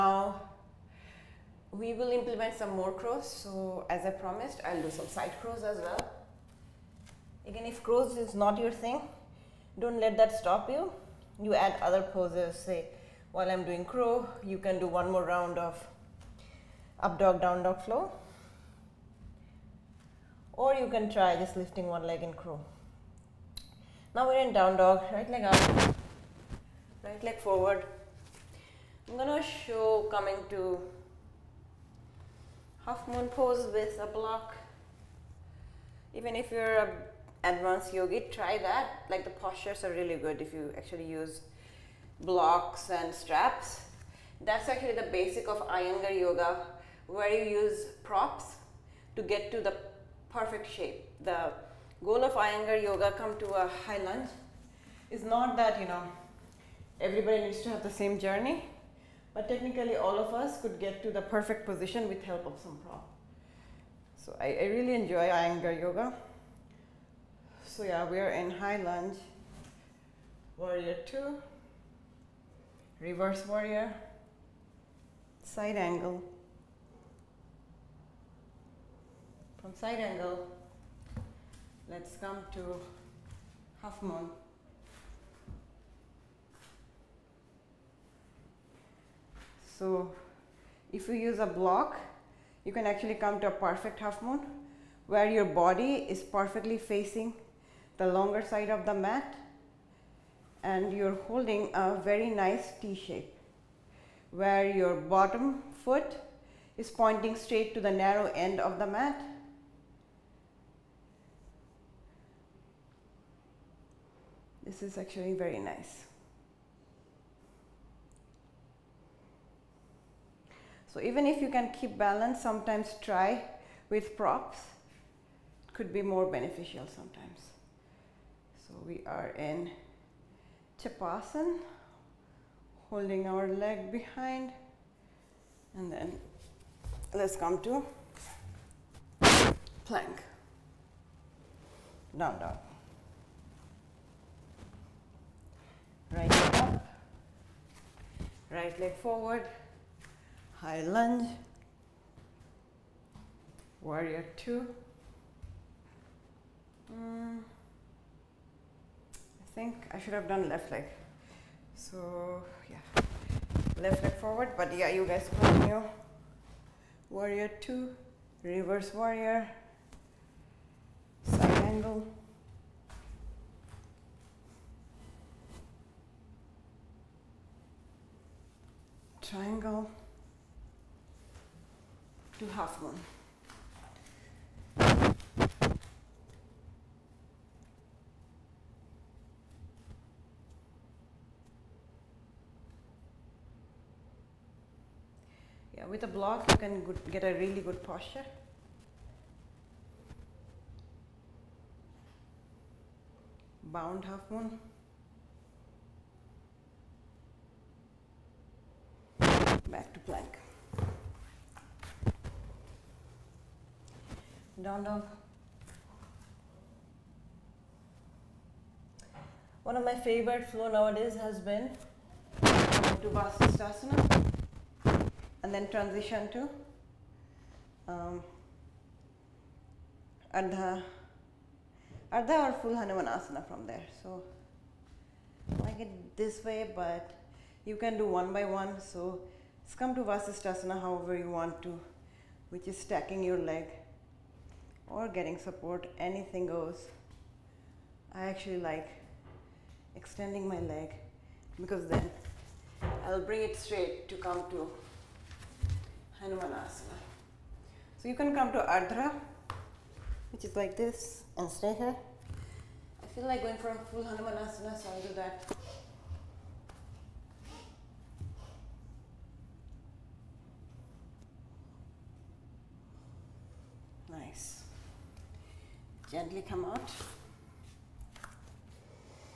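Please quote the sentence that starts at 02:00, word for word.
So even if you can keep balance, sometimes try with props.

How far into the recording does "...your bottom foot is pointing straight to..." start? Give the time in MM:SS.
01:44.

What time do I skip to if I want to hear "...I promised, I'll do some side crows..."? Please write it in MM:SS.
00:04.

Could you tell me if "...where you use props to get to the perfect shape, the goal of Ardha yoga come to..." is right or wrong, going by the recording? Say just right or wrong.
wrong.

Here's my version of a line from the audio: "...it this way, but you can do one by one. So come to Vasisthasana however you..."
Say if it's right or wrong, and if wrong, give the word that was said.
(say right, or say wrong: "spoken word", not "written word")
right.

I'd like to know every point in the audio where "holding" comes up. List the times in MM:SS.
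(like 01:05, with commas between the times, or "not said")
01:41, 02:12.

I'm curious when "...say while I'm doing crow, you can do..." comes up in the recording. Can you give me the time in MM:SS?
00:12.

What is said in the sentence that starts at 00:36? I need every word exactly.
Even if you're a advanced yogi, try that.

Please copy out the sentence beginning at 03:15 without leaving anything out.
Yeah, with a block you can get a really good posture.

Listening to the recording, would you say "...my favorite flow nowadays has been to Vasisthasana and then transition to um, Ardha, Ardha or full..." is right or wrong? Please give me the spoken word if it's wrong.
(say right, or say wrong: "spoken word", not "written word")
right.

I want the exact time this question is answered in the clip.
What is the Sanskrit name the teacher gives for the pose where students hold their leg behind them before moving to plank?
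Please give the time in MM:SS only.
02:10.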